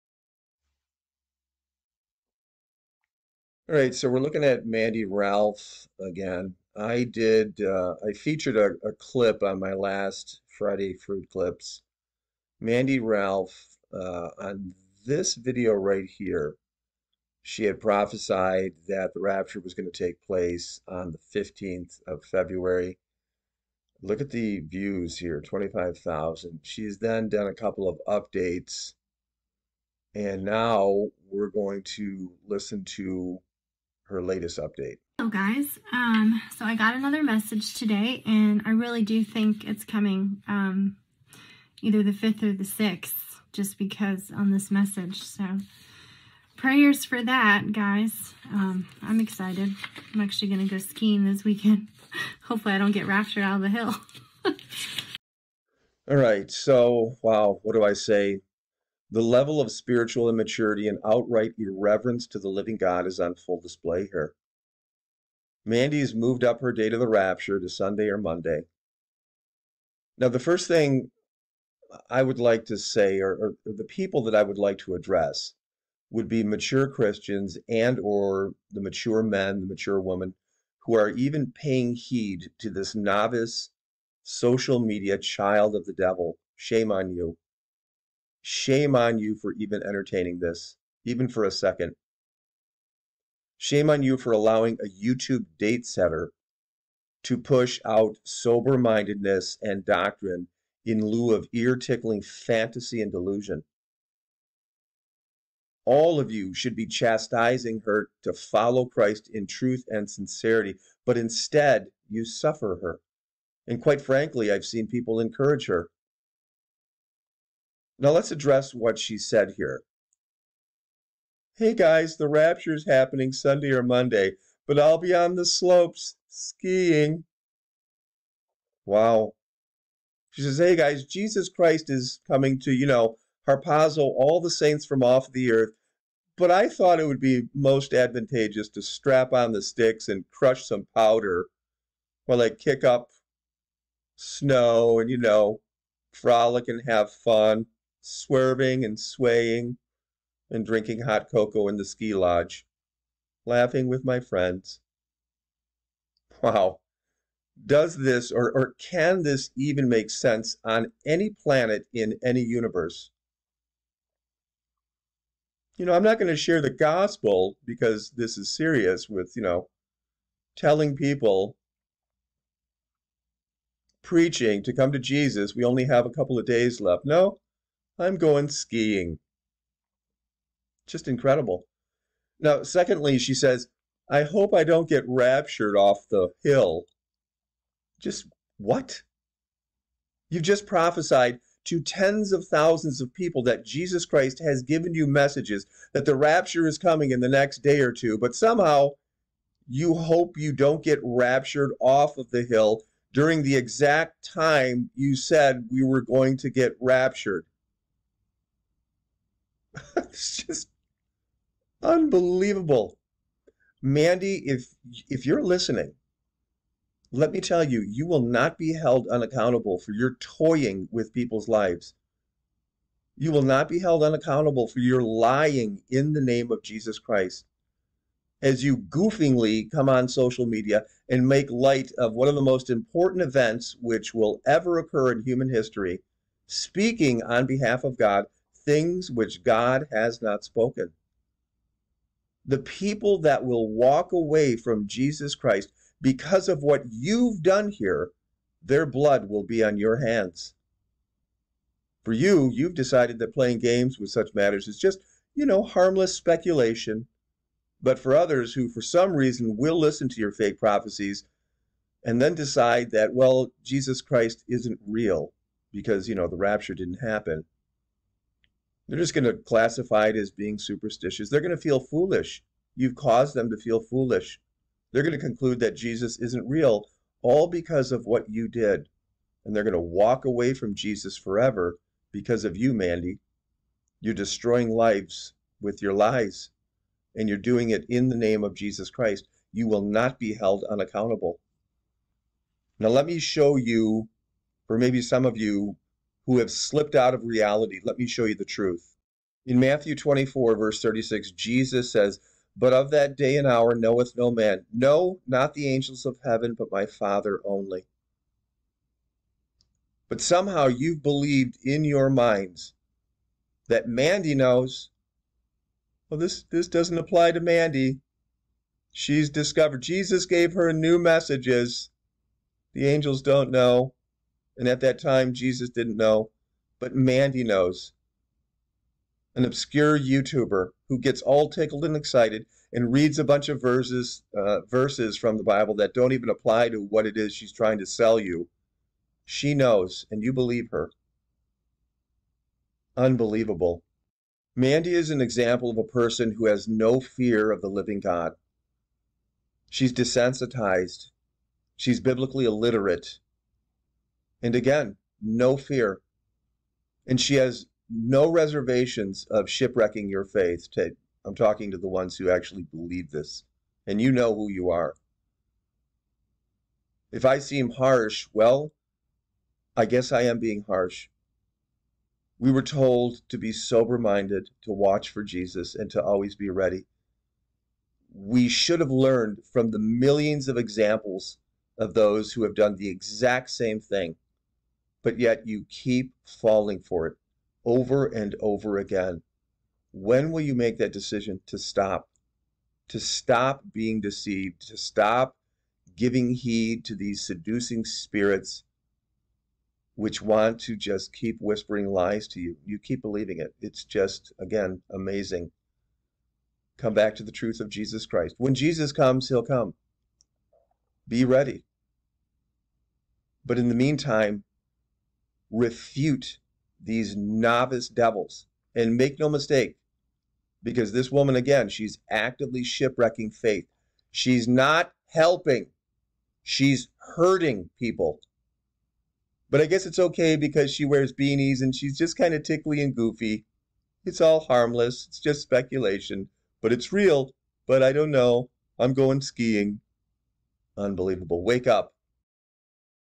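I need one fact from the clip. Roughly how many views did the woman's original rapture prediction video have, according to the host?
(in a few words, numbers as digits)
25,000.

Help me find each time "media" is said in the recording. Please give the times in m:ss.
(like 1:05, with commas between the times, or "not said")
1:24, 3:50.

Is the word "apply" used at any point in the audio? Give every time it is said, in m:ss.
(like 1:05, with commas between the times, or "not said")
5:16, 5:36.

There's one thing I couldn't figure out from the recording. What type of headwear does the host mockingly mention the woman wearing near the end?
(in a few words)
beanies.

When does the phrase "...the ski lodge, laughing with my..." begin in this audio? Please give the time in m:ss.
2:31.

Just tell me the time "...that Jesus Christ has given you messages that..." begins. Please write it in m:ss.
3:13.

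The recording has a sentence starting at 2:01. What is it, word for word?
Hey guys, the rapture is happening Sunday or Monday, but I'll be on the slopes skiing.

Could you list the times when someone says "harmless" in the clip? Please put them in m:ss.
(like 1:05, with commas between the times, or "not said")
4:15, 7:14.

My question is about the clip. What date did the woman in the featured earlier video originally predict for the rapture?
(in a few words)
February 15.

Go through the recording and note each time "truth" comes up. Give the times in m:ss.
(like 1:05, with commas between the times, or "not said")
1:49, 4:58, 6:47.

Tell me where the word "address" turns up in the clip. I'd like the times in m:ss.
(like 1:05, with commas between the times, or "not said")
1:14, 1:58.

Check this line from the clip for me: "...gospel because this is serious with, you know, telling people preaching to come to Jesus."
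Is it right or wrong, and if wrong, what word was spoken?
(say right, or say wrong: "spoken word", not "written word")
right.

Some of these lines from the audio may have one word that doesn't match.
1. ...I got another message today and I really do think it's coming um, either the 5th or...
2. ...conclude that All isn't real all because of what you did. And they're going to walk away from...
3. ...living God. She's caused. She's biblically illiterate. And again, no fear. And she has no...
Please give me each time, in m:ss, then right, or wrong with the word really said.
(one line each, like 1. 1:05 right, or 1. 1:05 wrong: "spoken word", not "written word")
1. 0:36 right
2. 4:35 wrong: "Jesus", not "All"
3. 5:47 wrong: "desensitized", not "caused".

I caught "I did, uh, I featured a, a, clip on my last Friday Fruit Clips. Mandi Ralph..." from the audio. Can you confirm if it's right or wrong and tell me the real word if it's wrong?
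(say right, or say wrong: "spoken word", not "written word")
right.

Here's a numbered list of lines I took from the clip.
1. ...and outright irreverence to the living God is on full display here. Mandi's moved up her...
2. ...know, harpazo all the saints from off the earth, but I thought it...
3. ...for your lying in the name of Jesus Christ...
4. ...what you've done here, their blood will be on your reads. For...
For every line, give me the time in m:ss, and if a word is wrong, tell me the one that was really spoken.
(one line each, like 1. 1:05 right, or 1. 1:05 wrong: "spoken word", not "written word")
1. 1:00 right
2. 2:12 right
3. 3:44 right
4. 4:06 wrong: "hands", not "reads".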